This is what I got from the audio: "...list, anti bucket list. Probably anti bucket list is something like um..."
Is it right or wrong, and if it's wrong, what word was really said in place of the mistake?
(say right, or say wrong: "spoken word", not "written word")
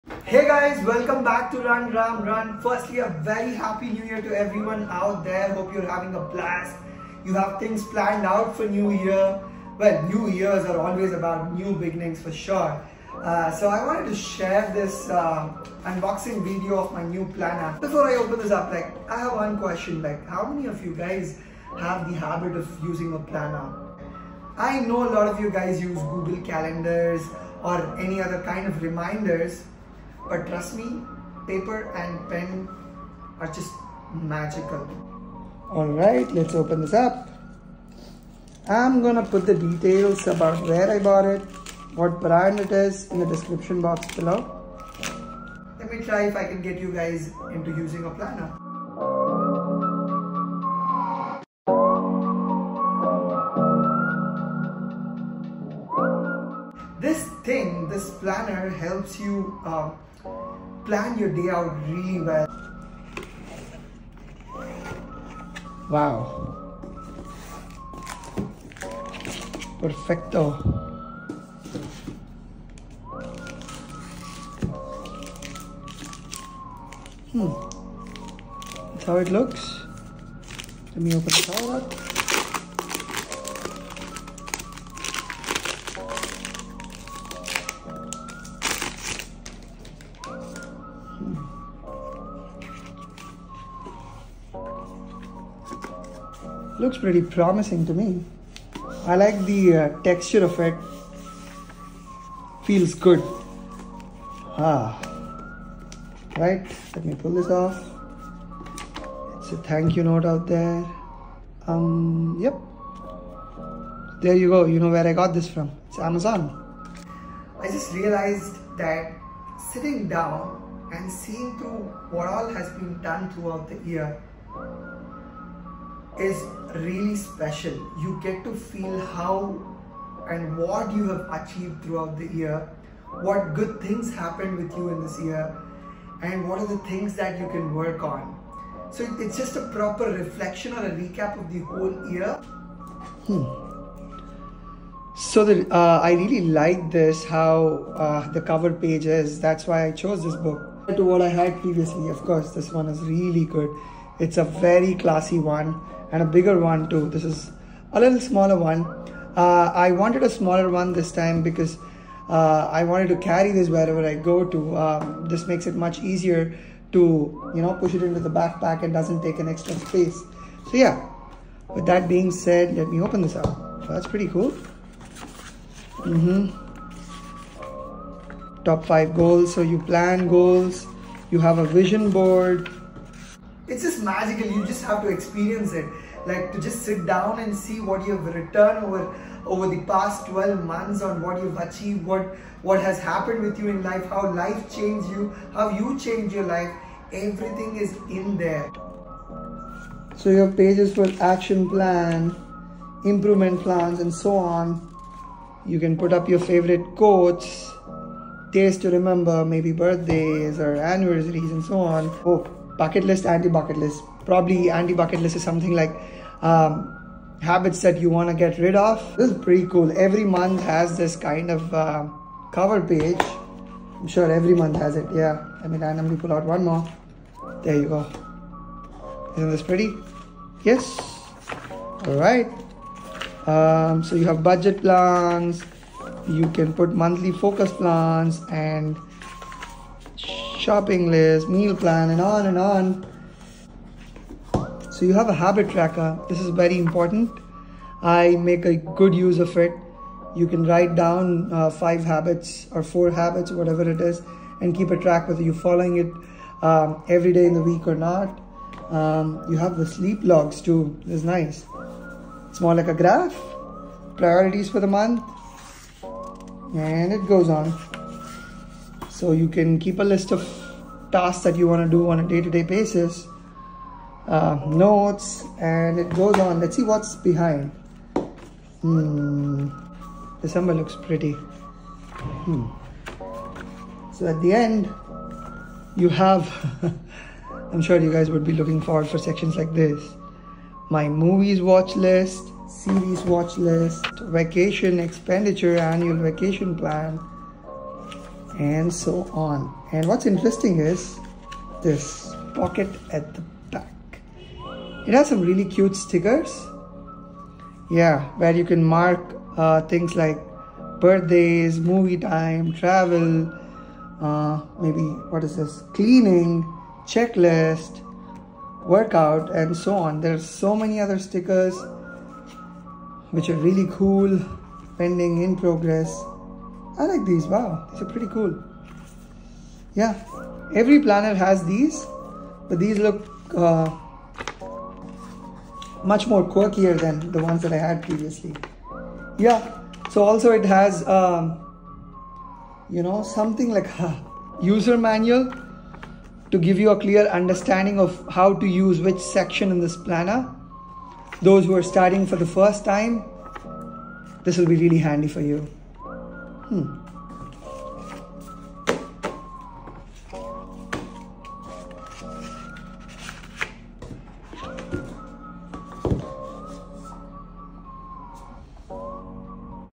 right.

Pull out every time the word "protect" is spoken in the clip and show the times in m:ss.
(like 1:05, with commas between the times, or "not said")
not said.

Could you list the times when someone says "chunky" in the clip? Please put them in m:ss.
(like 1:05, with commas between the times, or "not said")
not said.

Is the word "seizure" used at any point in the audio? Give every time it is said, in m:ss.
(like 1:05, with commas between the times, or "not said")
not said.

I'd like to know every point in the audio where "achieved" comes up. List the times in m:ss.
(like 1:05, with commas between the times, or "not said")
2:11, 3:11.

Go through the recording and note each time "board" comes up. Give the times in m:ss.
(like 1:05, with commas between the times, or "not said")
3:02.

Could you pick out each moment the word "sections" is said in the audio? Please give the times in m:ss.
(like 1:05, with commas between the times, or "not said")
4:49, 5:49.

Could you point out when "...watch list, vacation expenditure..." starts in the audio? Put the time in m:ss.
4:53.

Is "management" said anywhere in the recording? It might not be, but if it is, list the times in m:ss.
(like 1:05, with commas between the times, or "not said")
not said.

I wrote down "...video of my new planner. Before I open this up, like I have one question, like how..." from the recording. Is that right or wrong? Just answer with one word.
right.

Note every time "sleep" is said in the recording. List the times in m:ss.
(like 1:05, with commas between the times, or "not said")
4:19.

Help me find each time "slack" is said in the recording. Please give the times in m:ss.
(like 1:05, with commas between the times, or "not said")
not said.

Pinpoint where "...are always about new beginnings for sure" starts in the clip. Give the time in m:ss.
0:10.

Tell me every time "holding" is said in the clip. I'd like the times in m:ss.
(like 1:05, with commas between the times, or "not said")
not said.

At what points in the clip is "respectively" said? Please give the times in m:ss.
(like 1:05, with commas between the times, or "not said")
not said.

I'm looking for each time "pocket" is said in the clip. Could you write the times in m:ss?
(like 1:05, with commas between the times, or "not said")
5:02.